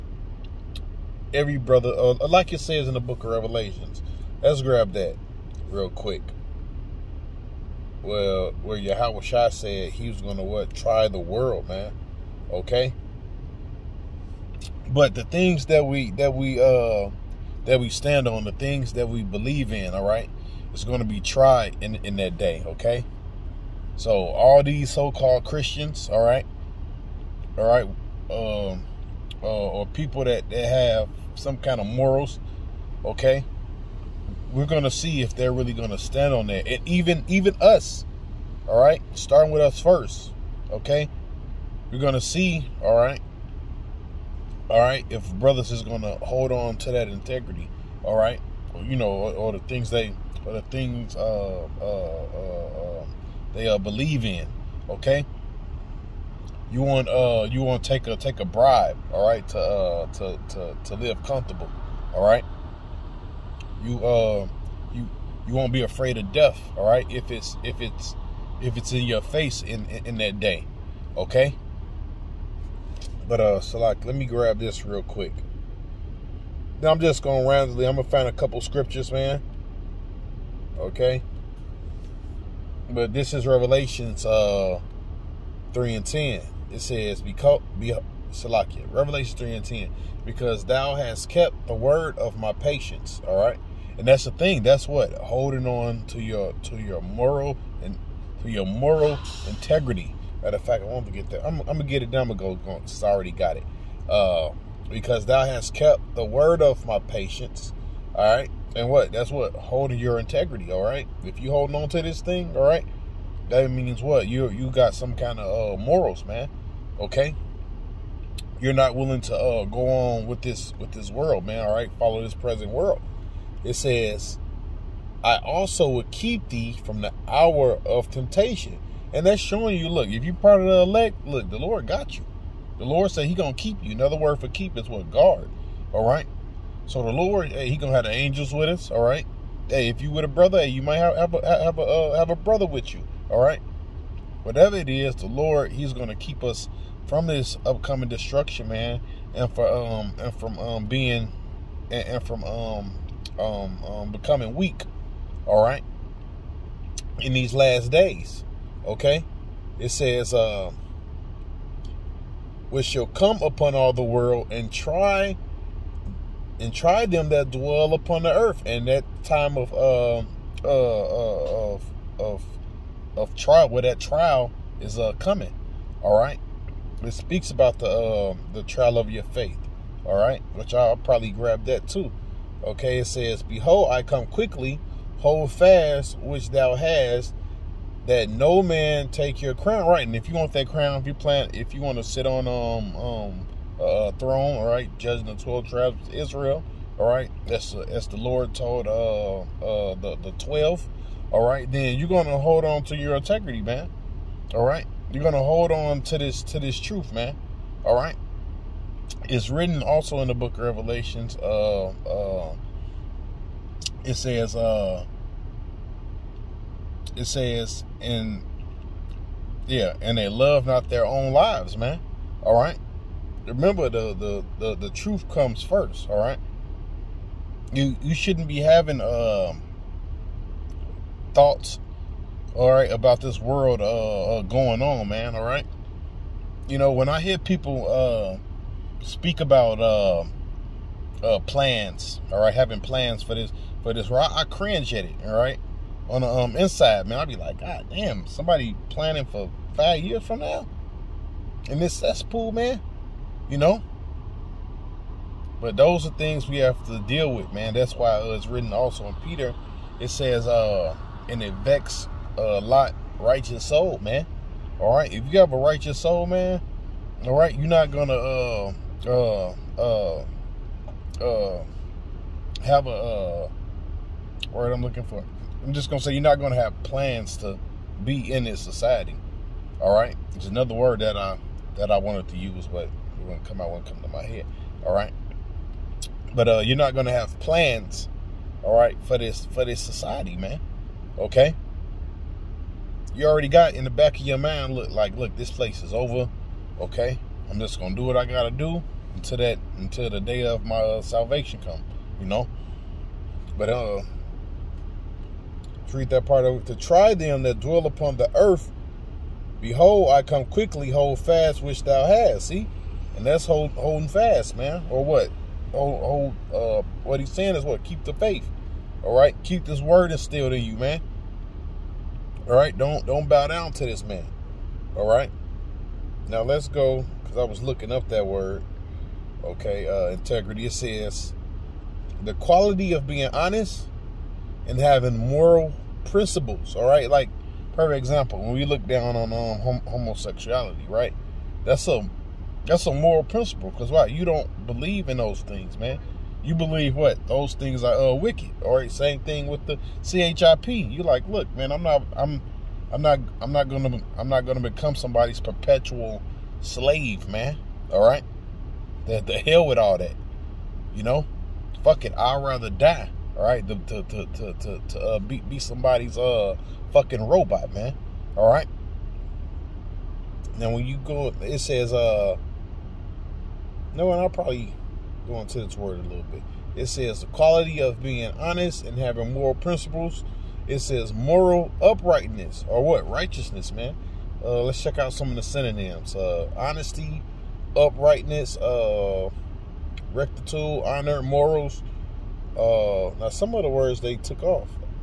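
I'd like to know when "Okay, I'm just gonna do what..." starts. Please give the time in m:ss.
4:56.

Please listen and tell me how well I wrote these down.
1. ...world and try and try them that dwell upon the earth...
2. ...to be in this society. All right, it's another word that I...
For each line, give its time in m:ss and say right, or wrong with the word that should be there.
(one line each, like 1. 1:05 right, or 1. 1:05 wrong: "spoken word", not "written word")
1. 2:44 right
2. 4:37 right.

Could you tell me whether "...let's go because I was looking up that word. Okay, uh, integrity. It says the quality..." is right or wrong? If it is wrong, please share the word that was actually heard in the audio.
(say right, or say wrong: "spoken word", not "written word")
right.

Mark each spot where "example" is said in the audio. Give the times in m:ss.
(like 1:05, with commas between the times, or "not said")
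5:37.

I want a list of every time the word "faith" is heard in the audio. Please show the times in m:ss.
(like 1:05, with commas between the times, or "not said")
2:59, 5:18.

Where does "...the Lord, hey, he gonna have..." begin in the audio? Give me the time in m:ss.
2:17.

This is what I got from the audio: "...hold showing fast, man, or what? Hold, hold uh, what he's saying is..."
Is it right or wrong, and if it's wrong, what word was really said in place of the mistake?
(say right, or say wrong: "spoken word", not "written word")
wrong: "holding", not "showing".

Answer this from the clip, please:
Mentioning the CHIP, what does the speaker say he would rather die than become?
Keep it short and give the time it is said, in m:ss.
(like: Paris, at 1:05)
Perpetual slave, at 5:55.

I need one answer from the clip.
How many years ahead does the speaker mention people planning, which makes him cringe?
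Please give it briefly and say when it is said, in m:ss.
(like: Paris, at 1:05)
5, at 4:09.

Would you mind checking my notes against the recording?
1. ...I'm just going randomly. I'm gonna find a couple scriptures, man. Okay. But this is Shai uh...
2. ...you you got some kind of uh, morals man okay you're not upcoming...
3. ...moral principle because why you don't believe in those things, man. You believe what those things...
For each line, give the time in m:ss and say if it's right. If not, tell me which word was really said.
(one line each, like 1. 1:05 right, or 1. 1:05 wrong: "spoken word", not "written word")
1. 1:16 wrong: "Revelations", not "Shai"
2. 1:54 wrong: "willing", not "upcoming"
3. 5:42 right.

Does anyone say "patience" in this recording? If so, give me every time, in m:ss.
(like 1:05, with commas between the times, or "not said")
1:32, 1:46.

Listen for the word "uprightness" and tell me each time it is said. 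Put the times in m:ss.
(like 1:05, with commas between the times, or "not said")
6:21, 6:27.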